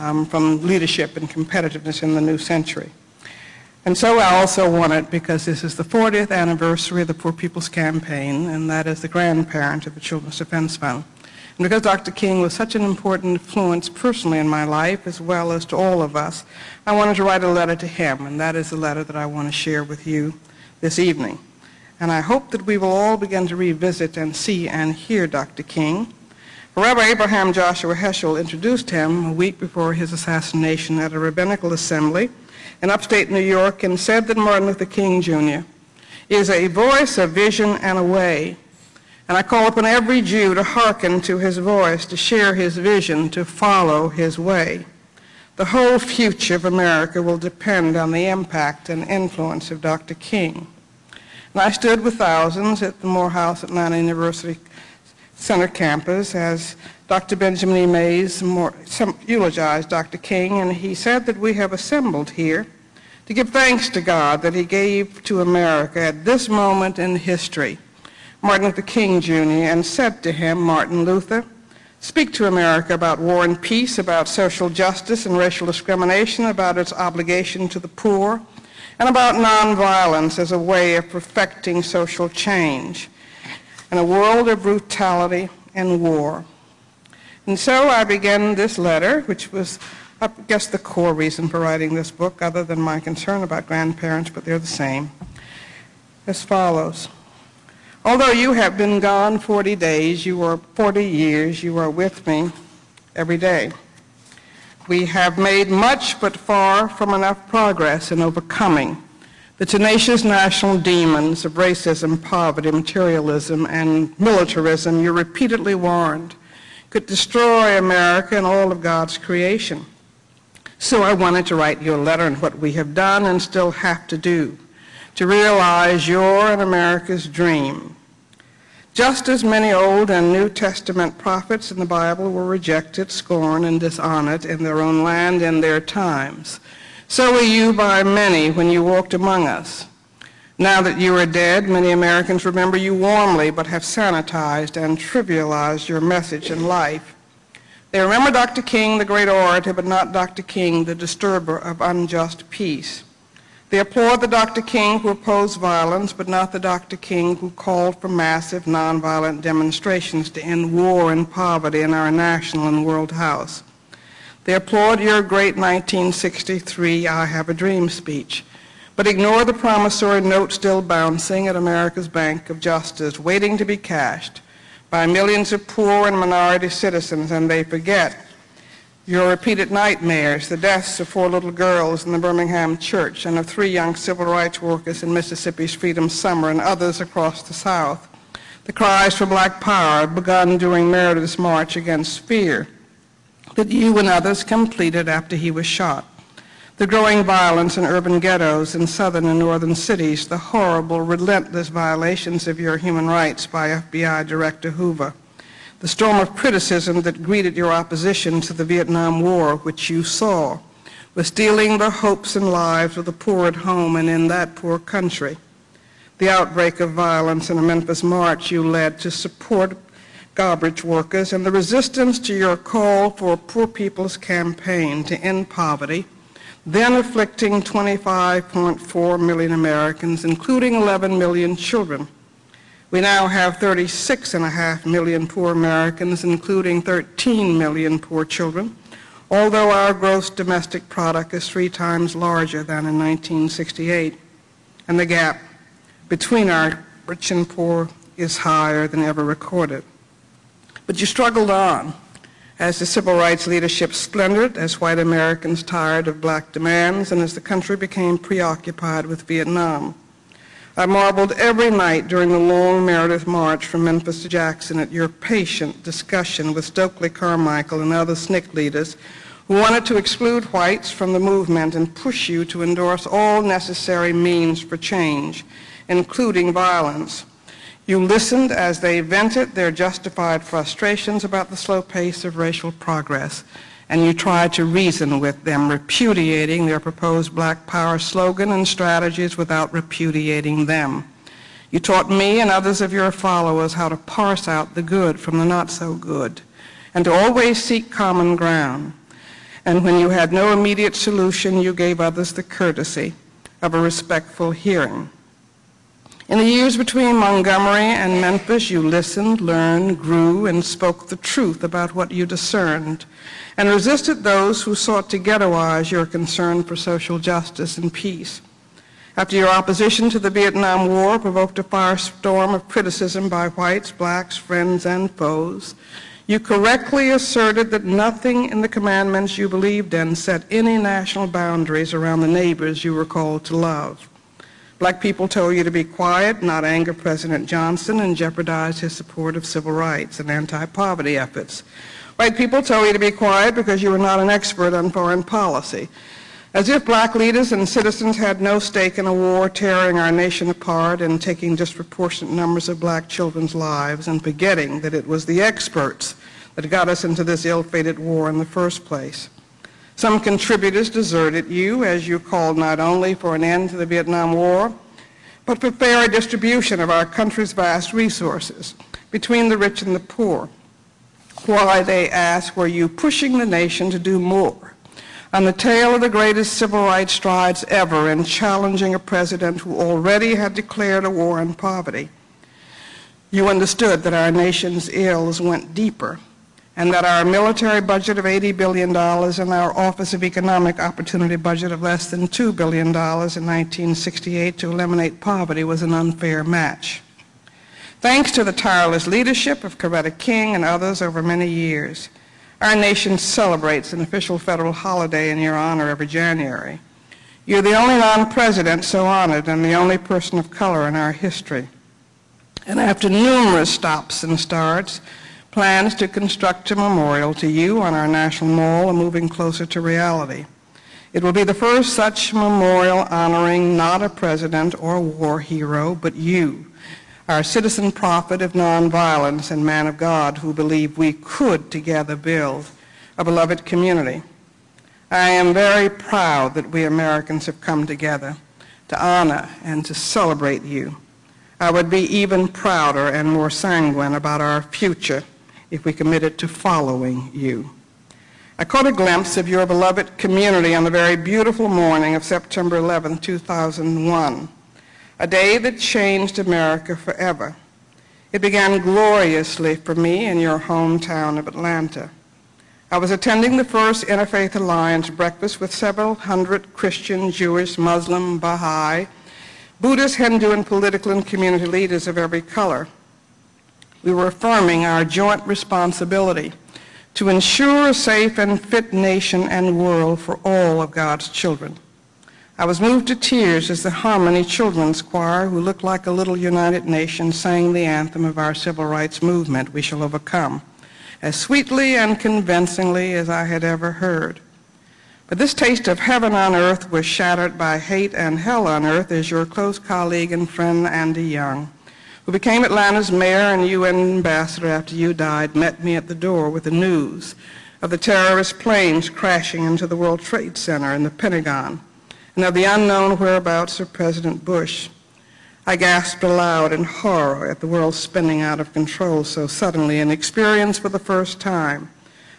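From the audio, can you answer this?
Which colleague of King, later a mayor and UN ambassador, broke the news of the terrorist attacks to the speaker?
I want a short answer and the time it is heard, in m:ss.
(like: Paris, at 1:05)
Andy Young, at 8:20.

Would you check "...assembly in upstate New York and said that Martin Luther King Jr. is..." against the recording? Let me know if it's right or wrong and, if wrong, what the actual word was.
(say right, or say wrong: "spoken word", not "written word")
right.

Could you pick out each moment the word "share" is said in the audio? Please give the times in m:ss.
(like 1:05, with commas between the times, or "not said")
0:19, 0:42.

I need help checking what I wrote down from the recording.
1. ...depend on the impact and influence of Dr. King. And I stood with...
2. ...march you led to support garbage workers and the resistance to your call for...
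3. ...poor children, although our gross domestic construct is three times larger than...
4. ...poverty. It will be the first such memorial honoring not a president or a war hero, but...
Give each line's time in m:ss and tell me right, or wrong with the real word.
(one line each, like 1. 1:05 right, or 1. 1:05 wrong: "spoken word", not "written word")
1. 0:47 right
2. 3:38 right
3. 3:57 wrong: "product", not "construct"
4. 6:59 wrong: "reality", not "poverty".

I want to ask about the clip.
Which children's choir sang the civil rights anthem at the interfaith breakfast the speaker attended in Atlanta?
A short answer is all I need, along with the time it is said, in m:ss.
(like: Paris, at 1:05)
Harmony Children's Choir, at 8:03.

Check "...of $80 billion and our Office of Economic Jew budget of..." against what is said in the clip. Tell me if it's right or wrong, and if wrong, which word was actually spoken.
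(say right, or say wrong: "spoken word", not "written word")
wrong: "Opportunity", not "Jew".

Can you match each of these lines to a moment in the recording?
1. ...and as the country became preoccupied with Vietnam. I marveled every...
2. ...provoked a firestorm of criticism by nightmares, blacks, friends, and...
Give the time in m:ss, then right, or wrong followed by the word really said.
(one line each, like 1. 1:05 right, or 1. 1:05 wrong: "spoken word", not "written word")
1. 4:17 right
2. 5:21 wrong: "whites", not "nightmares".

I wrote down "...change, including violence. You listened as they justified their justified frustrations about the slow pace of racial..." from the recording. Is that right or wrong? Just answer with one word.
wrong.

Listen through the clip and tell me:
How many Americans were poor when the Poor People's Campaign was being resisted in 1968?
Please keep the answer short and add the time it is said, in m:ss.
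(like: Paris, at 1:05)
25.4 million, at 3:47.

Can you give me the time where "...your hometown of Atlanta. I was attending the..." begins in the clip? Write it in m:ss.
7:40.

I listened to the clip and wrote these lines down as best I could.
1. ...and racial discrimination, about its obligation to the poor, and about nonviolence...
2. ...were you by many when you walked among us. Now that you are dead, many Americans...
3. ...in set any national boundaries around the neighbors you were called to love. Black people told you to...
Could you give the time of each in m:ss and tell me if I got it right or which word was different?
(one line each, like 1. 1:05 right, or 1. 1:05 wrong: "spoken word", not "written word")
1. 1:15 right
2. 2:17 right
3. 5:29 right.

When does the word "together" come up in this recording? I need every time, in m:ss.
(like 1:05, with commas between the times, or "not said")
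7:11, 7:17.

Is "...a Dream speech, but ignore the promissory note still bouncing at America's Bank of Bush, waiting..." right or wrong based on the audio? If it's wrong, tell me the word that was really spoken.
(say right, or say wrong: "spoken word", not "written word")
wrong: "Justice", not "Bush".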